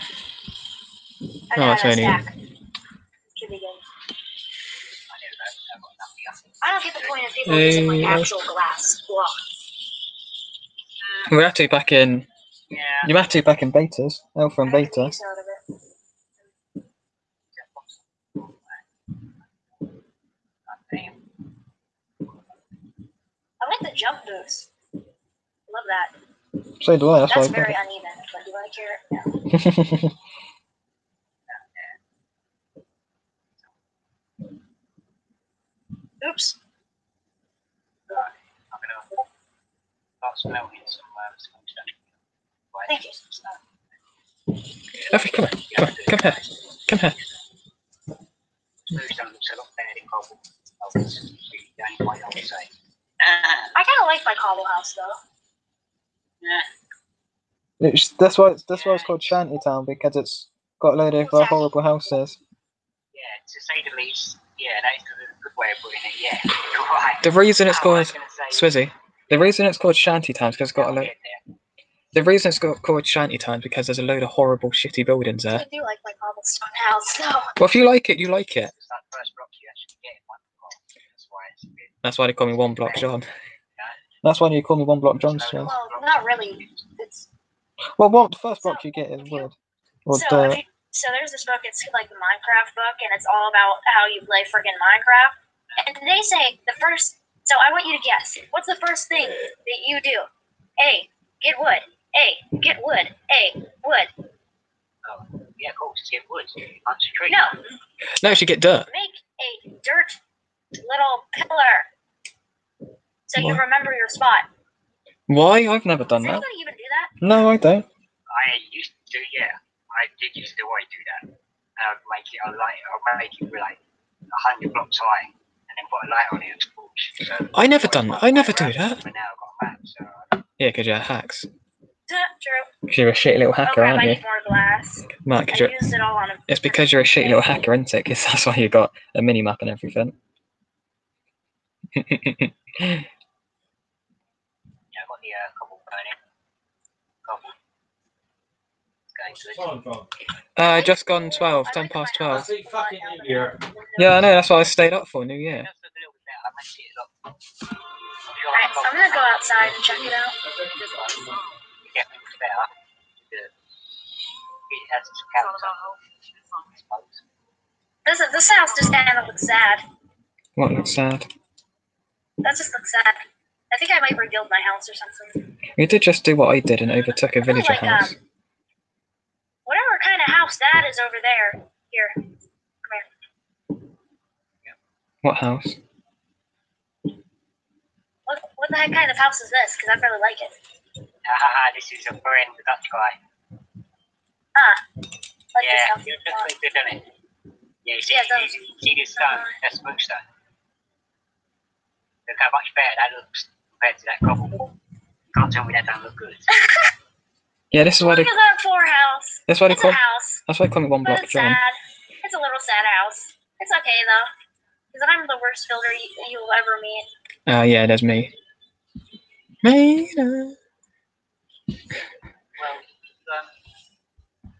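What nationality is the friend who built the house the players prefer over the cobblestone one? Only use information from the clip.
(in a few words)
Dutch.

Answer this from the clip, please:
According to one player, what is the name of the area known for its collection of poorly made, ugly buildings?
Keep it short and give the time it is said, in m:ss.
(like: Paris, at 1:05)
Shantytown, at 1:13.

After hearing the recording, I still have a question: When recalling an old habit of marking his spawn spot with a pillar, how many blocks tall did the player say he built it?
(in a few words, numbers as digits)
100.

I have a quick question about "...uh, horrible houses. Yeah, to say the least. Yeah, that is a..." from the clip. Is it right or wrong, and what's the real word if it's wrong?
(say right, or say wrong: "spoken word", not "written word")
right.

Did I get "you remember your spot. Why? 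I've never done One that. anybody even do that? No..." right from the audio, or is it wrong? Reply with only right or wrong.
wrong.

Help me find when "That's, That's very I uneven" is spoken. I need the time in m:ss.
0:27.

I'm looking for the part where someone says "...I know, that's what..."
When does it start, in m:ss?
2:34.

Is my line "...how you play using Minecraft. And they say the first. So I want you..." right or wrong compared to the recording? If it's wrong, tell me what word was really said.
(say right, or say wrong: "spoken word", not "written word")
wrong: "freaking", not "using".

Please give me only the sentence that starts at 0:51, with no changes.
what uh, y'all I kind of like my Cobble House though.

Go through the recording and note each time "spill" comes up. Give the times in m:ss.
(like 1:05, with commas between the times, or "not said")
not said.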